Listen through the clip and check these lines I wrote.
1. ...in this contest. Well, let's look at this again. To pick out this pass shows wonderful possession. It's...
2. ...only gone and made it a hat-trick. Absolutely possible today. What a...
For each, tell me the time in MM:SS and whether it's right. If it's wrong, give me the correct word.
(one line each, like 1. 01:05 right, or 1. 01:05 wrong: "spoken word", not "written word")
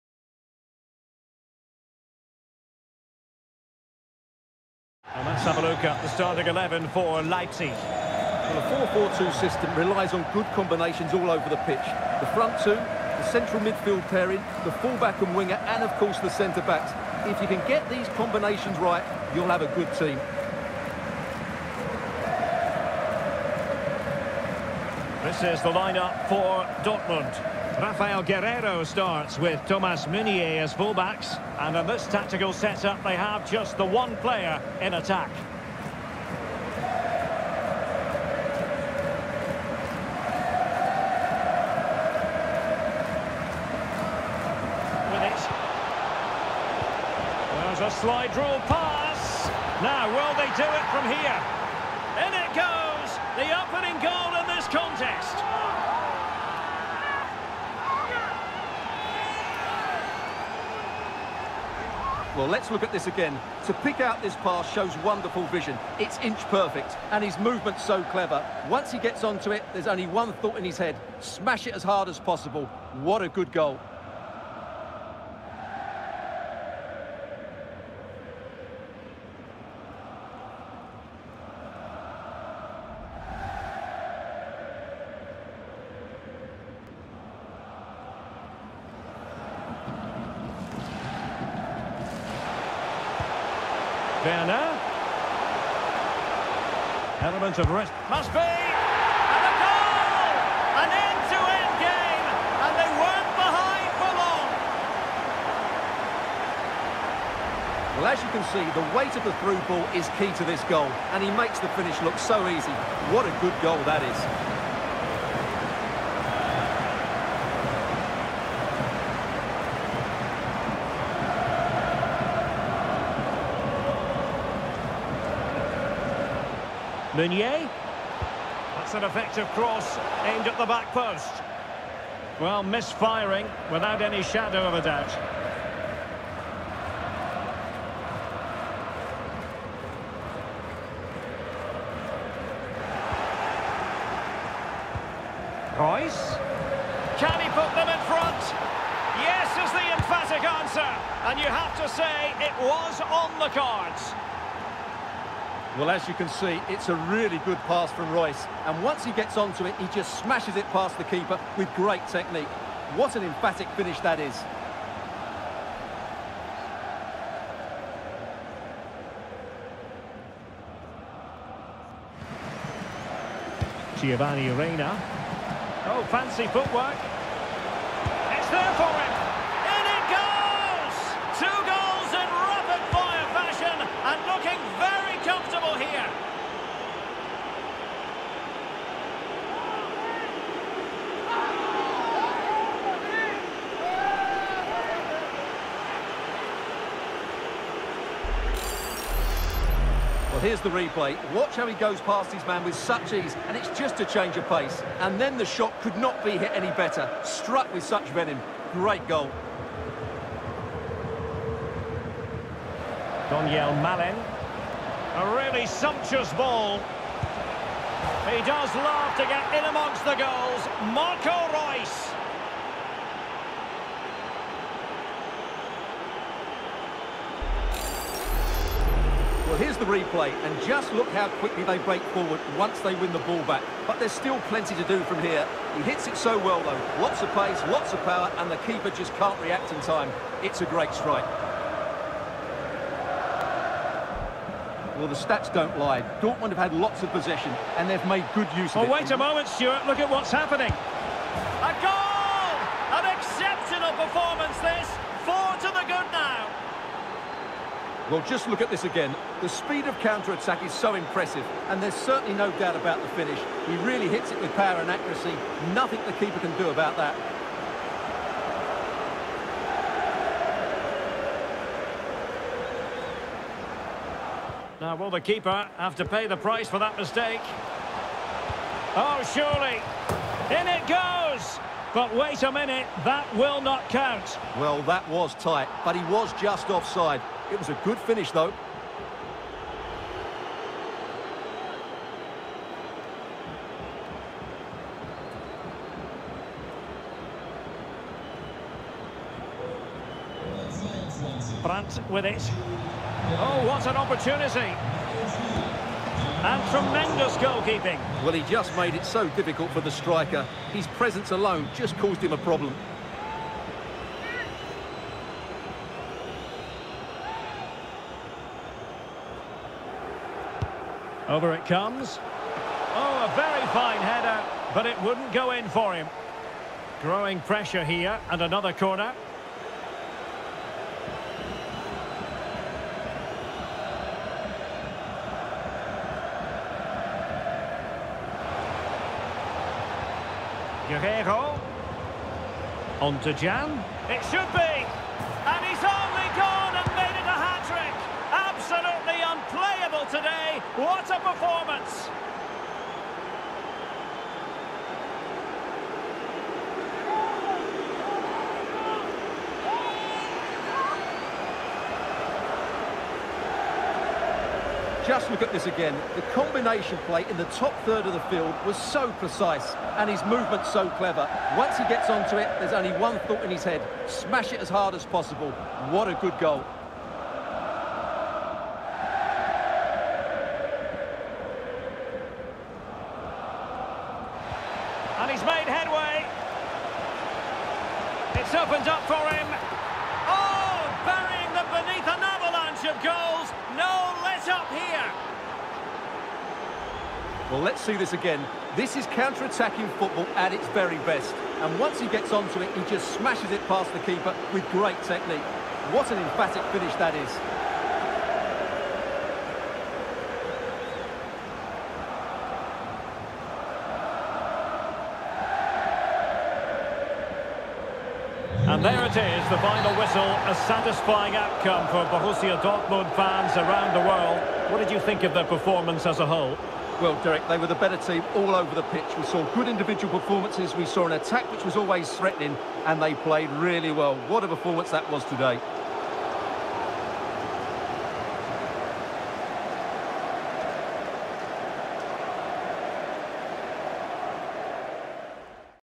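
1. 00:54 wrong: "vision", not "possession"
2. 05:45 wrong: "unplayable", not "possible".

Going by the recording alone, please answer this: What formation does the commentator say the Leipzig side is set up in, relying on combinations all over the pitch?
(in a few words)
4-4-2.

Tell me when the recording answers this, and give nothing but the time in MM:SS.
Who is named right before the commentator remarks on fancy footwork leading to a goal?
02:54.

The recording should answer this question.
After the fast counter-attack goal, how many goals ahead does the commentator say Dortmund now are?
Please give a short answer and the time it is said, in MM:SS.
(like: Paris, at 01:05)
4, at 04:15.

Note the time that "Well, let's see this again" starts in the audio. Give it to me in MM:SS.
06:37.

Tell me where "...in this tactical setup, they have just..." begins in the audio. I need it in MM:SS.
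00:31.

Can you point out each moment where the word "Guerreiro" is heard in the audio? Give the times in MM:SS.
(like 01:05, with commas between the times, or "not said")
00:28, 05:40.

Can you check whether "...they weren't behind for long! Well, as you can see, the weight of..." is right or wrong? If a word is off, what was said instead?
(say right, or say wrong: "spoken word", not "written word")
right.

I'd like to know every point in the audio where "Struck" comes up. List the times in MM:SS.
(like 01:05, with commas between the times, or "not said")
03:27.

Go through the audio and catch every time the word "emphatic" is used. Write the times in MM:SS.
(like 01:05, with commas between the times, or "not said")
02:29, 02:43, 06:46.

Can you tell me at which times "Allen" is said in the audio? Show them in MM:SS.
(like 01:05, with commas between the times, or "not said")
not said.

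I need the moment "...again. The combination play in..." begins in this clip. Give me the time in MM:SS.
06:05.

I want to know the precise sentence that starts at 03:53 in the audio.
But there's still plenty to do from here.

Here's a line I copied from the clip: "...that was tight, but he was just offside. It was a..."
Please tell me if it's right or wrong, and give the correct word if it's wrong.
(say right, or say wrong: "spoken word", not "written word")
right.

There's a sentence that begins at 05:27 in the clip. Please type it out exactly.
Growing pressure here, and another corner.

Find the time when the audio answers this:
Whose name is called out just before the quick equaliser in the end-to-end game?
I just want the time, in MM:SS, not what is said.
01:34.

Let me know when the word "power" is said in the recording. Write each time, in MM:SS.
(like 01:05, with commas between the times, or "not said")
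03:58, 04:24.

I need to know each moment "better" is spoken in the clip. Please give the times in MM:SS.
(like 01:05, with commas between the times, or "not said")
03:26, 07:07.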